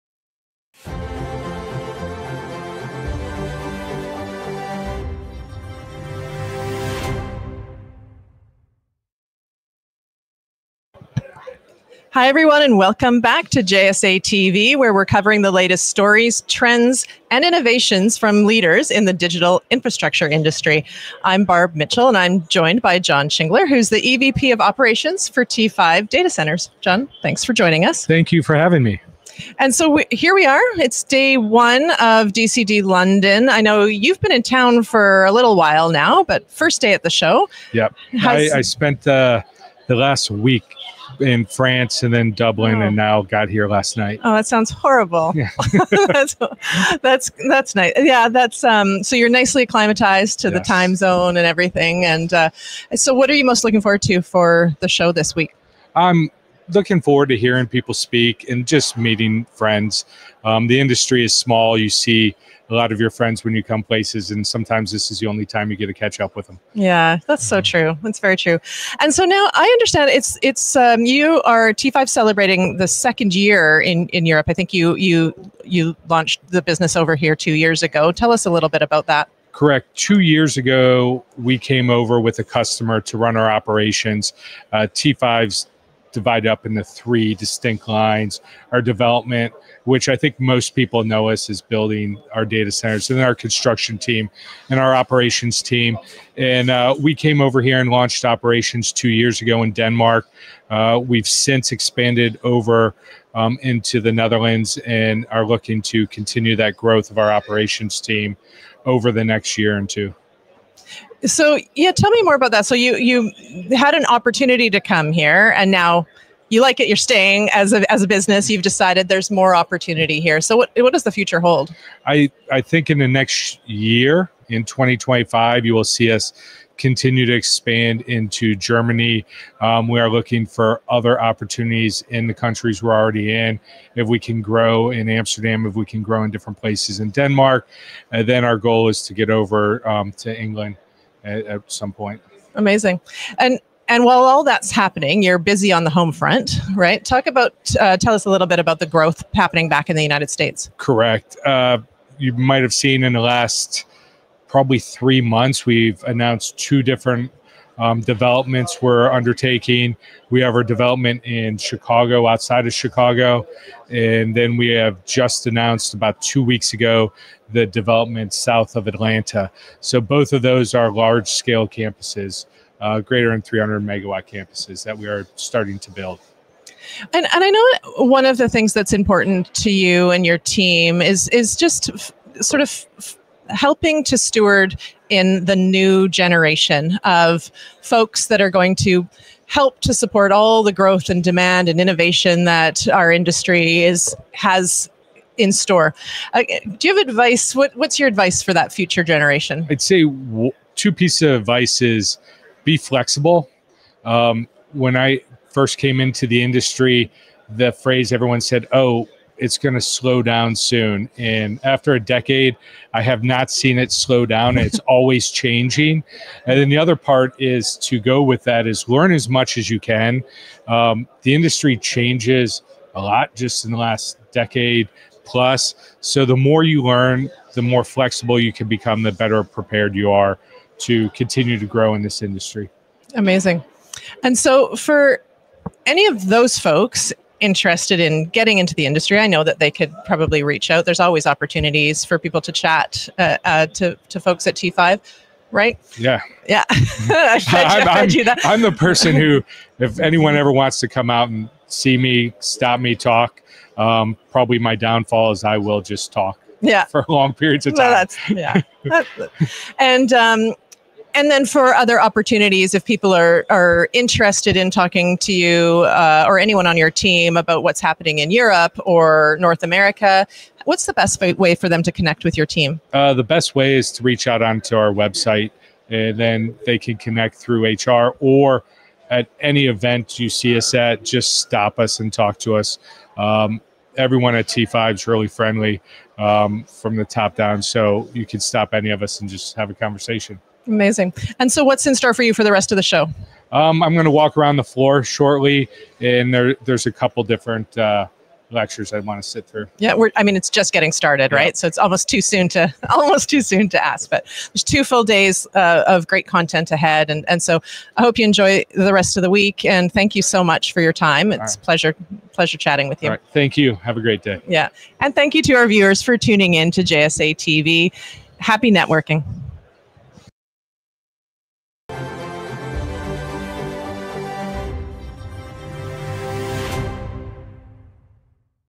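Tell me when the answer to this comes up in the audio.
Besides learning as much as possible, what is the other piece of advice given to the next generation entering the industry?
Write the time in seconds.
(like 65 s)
202 s.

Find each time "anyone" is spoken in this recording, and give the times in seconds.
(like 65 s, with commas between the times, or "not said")
249 s, 266 s.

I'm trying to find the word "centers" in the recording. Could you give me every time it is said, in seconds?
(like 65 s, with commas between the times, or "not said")
26 s, 92 s.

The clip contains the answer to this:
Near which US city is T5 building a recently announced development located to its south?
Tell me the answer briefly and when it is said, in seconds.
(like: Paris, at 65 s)
Atlanta, at 168 s.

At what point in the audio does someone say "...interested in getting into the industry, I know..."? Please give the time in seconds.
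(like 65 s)
237 s.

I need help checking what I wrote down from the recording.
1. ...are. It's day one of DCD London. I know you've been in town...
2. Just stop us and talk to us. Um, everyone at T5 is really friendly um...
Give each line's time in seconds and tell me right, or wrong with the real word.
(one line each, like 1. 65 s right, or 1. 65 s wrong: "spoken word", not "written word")
1. 30 s right
2. 281 s right.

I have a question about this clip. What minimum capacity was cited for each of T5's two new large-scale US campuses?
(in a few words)
300 megawatts.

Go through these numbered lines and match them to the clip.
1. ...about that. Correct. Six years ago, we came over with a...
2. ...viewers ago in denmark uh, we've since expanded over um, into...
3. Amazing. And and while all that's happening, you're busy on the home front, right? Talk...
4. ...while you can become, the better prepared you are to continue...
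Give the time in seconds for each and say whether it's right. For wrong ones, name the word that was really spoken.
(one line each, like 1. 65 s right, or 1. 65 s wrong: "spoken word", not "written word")
1. 78 s wrong: "Two", not "Six"
2. 99 s wrong: "years", not "viewers"
3. 142 s right
4. 227 s wrong: "flexible", not "while".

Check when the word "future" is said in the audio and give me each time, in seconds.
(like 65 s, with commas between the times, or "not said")
121 s, 198 s.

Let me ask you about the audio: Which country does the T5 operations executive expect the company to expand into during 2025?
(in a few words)
Germany.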